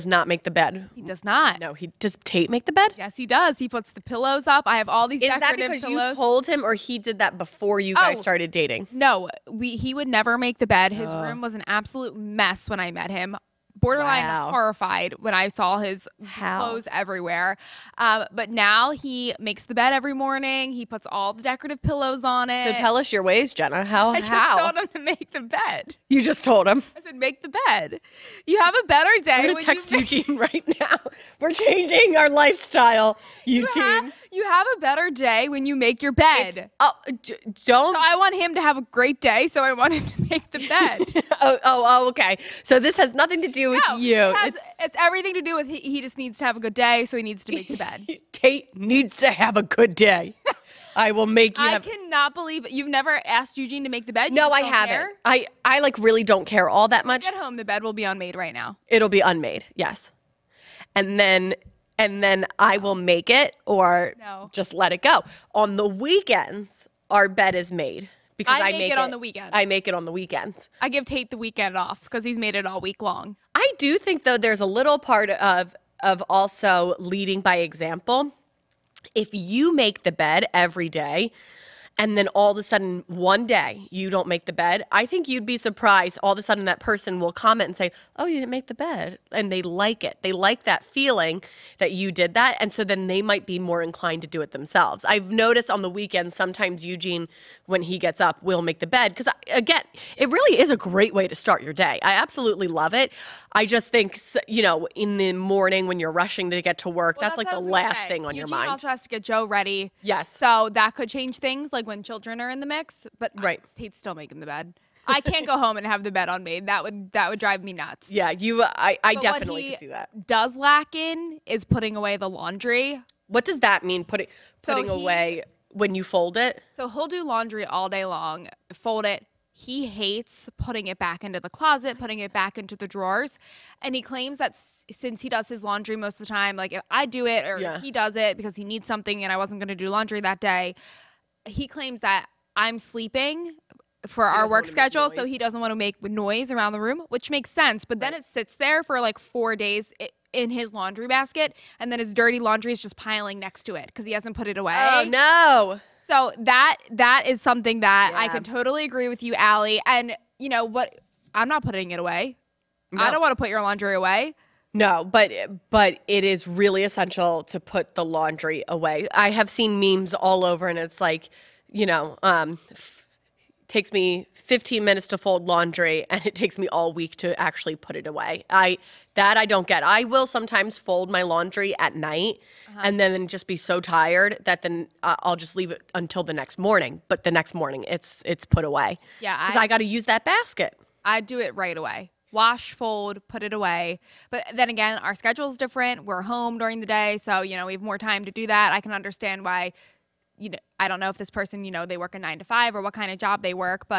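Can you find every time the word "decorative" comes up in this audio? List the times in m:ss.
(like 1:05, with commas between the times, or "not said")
0:05, 0:21.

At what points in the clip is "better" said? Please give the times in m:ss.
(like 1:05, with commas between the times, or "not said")
0:28, 0:34.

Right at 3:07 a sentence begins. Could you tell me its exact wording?
But the next morning, it's it's put away.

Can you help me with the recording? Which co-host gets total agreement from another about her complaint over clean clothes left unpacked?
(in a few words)
Allie.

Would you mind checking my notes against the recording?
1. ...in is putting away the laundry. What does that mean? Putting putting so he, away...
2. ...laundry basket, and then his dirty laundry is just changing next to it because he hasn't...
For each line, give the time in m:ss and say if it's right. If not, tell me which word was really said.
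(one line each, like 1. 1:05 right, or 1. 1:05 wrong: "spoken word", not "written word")
1. 2:00 right
2. 2:30 wrong: "piling", not "changing".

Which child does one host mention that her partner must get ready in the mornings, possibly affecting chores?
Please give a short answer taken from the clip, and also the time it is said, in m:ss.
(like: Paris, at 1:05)
Joe, at 1:49.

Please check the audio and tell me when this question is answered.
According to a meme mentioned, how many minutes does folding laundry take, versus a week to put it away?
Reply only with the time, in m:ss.
2:54.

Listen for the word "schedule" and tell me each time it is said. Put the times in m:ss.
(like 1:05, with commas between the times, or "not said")
2:24, 3:15.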